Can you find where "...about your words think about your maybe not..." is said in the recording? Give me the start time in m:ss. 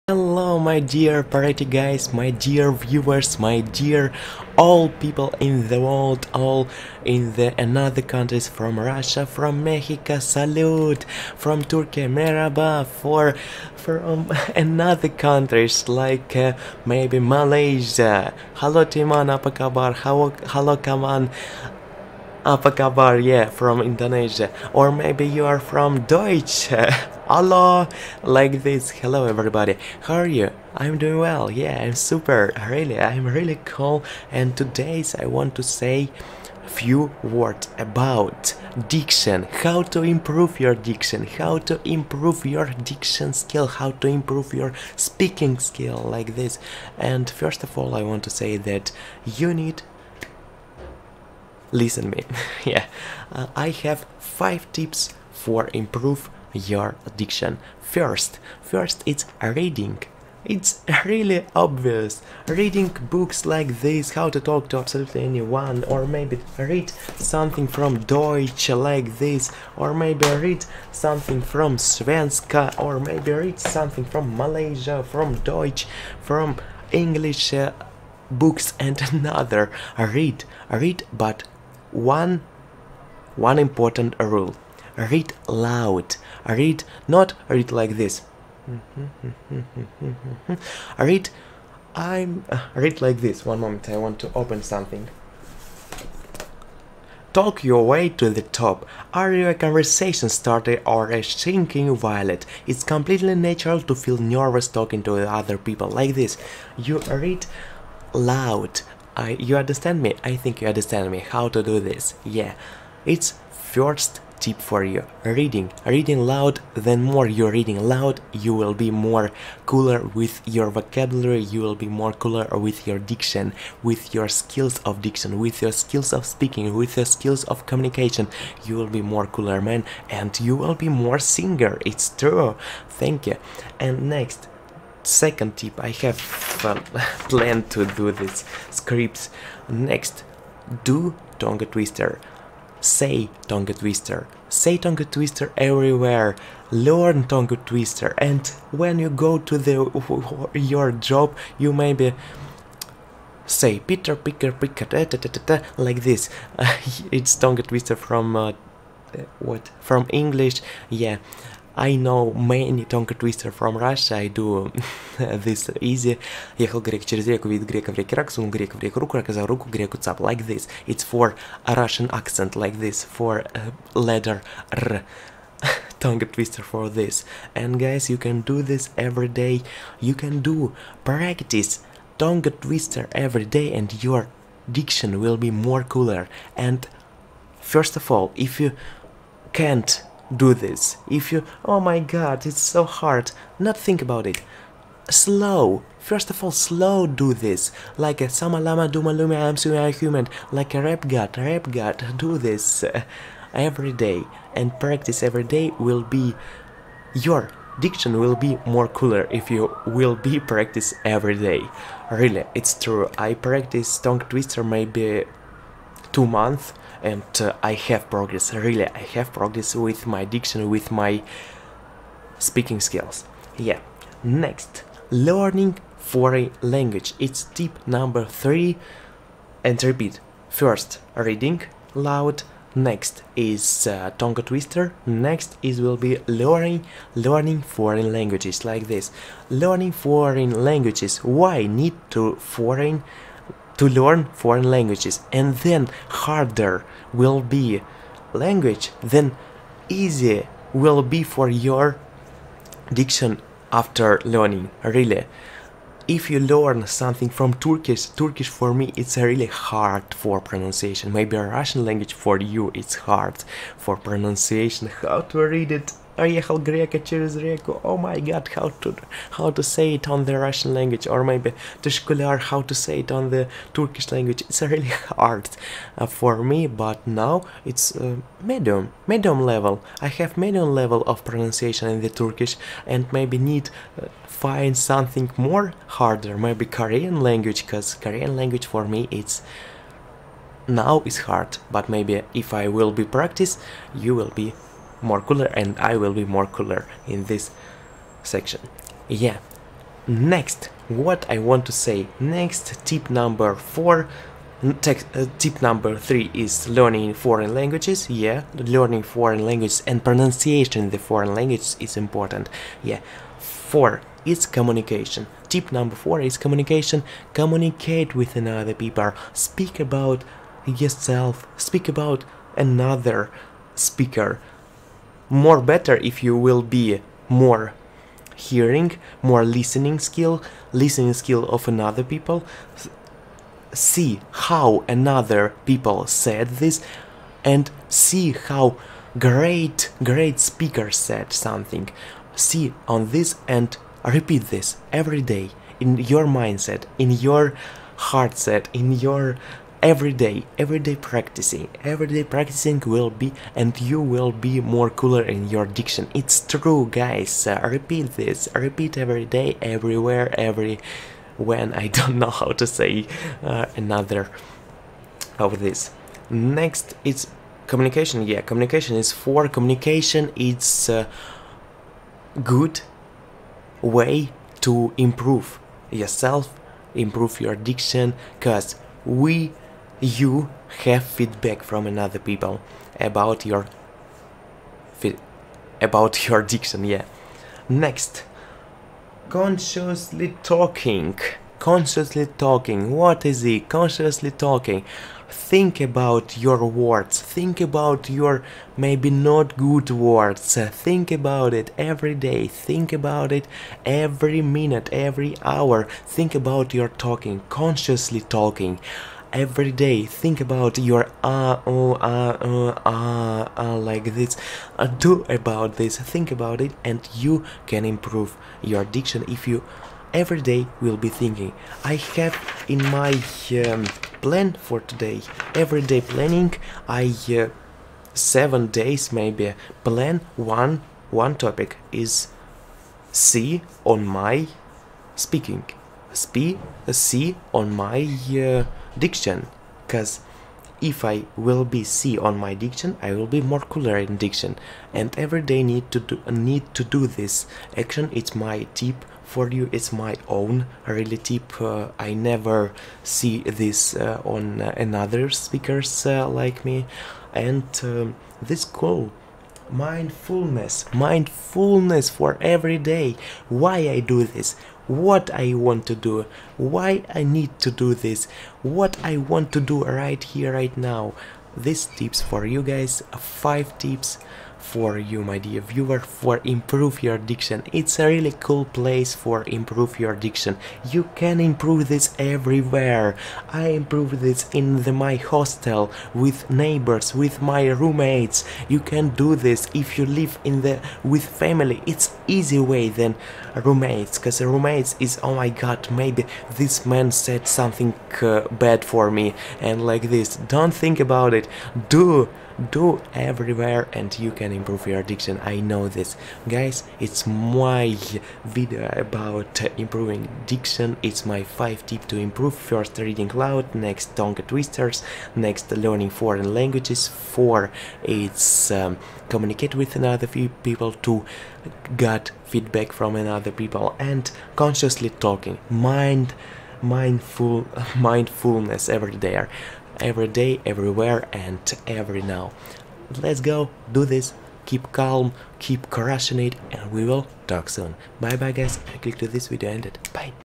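6:35.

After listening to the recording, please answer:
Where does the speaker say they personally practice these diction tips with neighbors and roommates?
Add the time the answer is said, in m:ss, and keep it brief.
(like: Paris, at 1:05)
Hostel, at 8:04.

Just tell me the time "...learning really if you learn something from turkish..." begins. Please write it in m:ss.
4:14.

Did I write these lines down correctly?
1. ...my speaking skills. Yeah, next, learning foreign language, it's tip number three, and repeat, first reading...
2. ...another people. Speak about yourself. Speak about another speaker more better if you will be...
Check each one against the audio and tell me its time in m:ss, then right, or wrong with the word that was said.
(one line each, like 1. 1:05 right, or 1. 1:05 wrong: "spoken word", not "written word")
1. 3:40 right
2. 5:18 right.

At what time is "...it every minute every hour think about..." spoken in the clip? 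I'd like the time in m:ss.
6:43.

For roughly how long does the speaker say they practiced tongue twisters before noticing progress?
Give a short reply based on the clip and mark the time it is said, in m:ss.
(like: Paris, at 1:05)
2 months, at 3:36.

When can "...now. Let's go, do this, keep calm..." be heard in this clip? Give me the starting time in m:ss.
8:52.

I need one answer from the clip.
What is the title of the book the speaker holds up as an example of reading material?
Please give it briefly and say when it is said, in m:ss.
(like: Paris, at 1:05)
How to Talk to Absolutely Anyone, at 1:04.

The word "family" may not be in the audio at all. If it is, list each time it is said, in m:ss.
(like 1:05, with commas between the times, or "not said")
8:11.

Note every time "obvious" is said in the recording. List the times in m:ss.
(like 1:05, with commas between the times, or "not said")
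1:01.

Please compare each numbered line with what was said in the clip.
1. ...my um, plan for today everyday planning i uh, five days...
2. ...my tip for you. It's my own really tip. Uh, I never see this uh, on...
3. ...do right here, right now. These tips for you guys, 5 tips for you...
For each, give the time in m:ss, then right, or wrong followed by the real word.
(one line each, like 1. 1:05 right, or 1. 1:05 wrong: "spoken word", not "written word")
1. 7:02 wrong: "seven", not "five"
2. 7:28 right
3. 7:49 right.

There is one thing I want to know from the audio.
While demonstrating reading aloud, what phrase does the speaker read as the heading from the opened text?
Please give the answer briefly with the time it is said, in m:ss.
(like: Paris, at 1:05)
Talk your way to the top, at 1:37.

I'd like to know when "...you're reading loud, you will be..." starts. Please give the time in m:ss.
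1:57.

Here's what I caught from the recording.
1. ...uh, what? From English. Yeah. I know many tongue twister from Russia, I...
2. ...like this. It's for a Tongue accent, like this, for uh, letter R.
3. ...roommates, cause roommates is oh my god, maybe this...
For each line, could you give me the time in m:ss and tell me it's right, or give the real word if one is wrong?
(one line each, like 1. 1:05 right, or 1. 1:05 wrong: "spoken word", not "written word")
1. 2:38 right
2. 2:50 wrong: "Russian", not "Tongue"
3. 8:13 right.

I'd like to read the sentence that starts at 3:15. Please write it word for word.
Slow, first of all, slow do this.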